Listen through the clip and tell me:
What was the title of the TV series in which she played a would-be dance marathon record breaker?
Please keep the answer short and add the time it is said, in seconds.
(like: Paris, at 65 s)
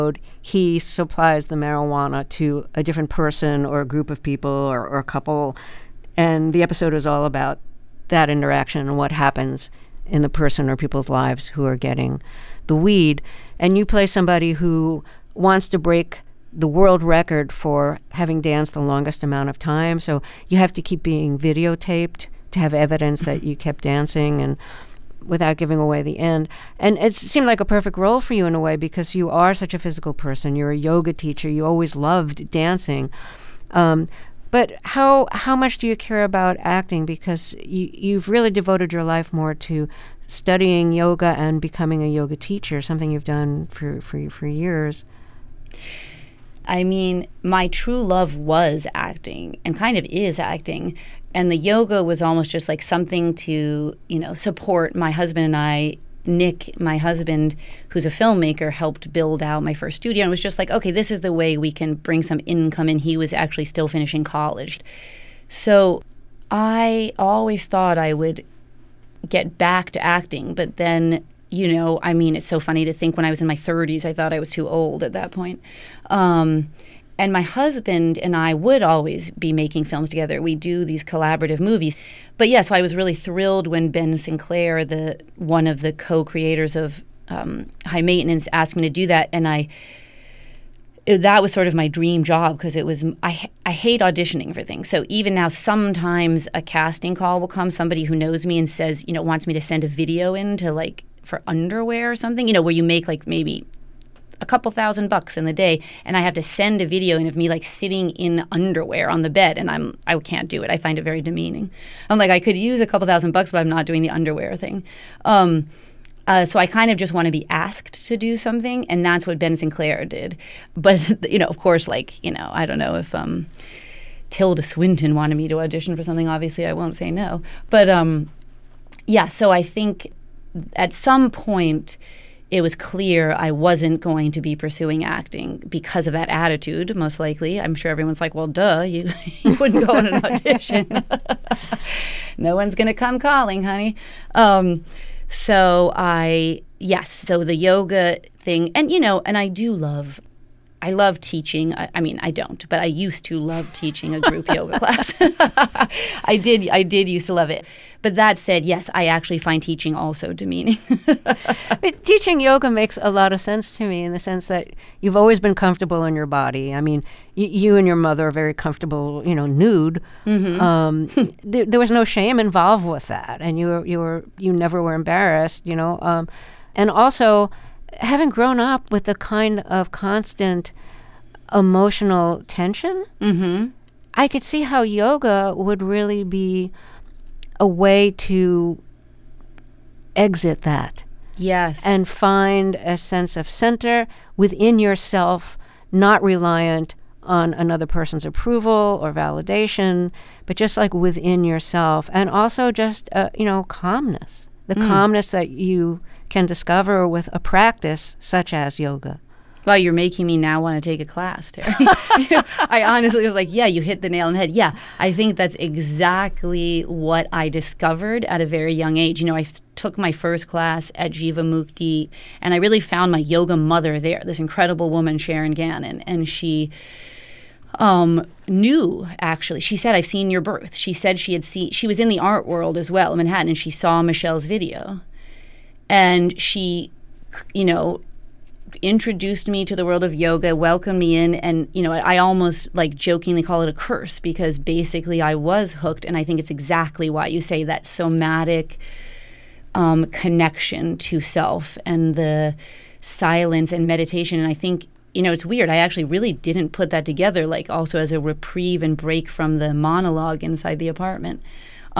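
High Maintenance, at 87 s.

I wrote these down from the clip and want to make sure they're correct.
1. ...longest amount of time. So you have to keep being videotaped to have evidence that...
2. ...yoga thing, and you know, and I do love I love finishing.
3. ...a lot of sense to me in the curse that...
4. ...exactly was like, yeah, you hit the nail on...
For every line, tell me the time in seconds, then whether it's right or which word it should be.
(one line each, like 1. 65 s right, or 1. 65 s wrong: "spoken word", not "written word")
1. 18 s right
2. 147 s wrong: "teaching", not "finishing"
3. 162 s wrong: "sense", not "curse"
4. 212 s wrong: "honestly", not "exactly".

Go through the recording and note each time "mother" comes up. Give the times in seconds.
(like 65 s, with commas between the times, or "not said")
167 s, 223 s.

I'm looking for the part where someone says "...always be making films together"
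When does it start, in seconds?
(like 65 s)
78 s.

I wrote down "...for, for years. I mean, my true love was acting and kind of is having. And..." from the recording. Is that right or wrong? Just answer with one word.
wrong.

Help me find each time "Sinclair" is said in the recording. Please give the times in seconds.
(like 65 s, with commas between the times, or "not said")
84 s, 119 s.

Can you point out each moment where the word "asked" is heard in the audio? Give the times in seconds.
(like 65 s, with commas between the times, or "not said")
88 s, 117 s.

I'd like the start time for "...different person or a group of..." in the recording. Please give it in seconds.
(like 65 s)
2 s.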